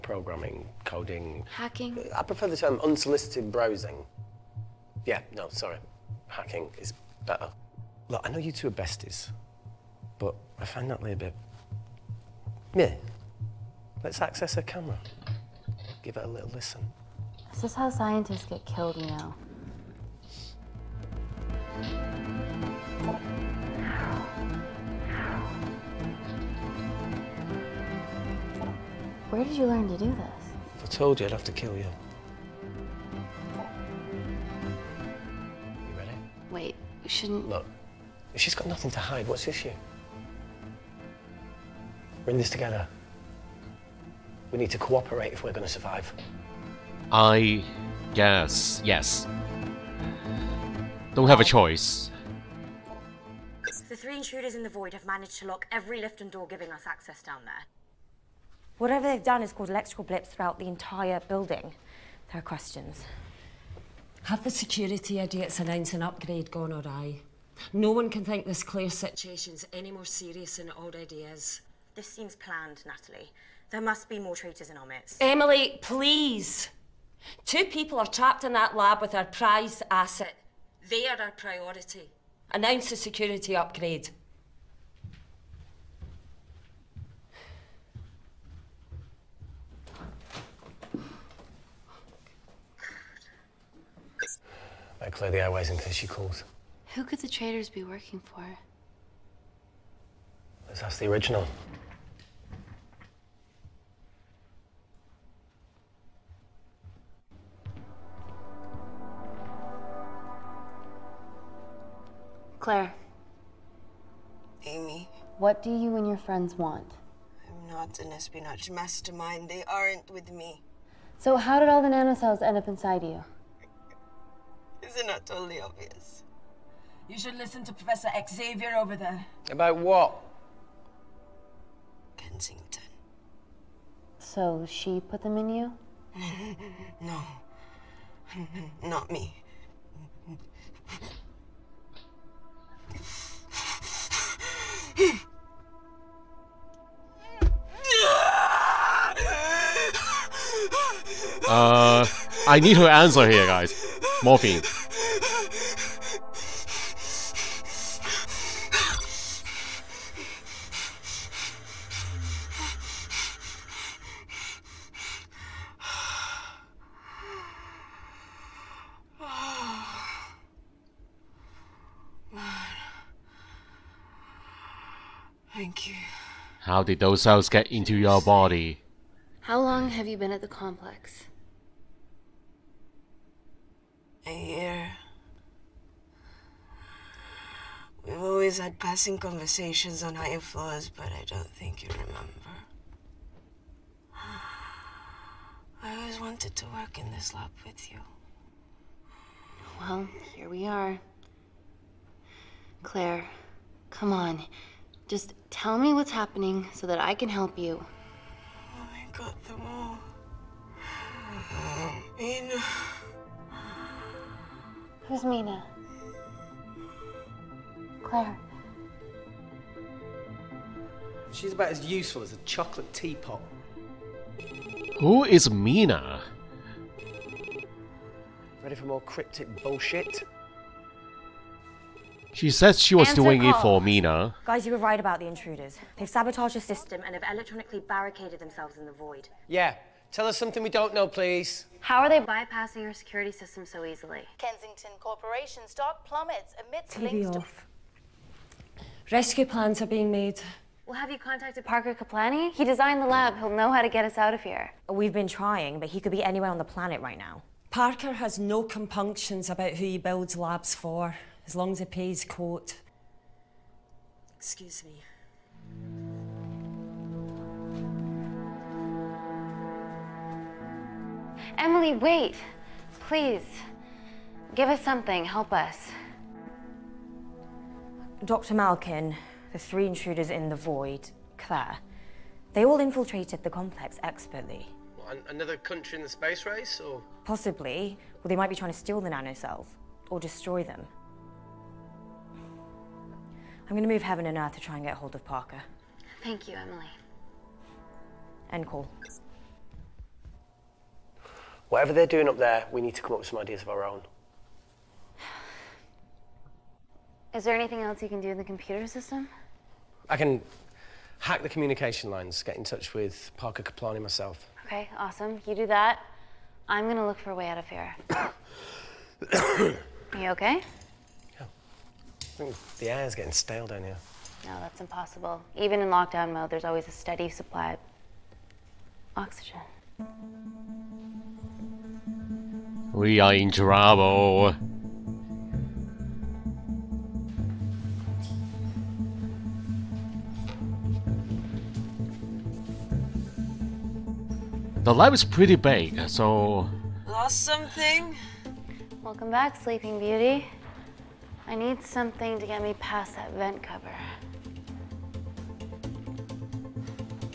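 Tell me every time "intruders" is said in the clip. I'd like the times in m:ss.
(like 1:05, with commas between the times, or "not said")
0:54, 3:55, 4:39.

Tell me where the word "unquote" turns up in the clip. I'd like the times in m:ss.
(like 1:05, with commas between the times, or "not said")
not said.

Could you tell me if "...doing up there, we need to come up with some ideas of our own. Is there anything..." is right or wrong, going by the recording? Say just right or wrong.
right.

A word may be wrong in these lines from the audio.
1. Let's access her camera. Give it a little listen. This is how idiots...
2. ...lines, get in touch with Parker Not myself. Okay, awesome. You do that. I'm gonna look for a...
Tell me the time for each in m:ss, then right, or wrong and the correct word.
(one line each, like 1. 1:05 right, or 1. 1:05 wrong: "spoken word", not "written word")
1. 0:14 wrong: "scientists", not "idiots"
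2. 5:12 wrong: "Kaplani", not "Not".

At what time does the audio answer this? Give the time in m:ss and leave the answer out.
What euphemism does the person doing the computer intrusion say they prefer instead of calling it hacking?
0:02.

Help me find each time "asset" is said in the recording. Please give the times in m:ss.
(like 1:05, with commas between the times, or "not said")
1:19.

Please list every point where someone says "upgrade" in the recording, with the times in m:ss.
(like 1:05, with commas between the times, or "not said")
1:06, 1:23.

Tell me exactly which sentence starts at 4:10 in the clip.
Well, have you contacted Parker Kaplani?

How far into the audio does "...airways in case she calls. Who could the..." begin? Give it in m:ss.
1:35.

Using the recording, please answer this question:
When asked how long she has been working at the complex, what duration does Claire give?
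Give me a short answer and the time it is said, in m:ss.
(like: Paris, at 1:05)
A year, at 3:04.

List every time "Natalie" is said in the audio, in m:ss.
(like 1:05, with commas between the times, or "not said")
0:10, 1:12.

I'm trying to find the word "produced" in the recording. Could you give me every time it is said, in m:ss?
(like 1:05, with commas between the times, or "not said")
not said.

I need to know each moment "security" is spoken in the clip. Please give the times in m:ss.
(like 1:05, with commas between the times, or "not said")
1:04, 1:22, 4:02.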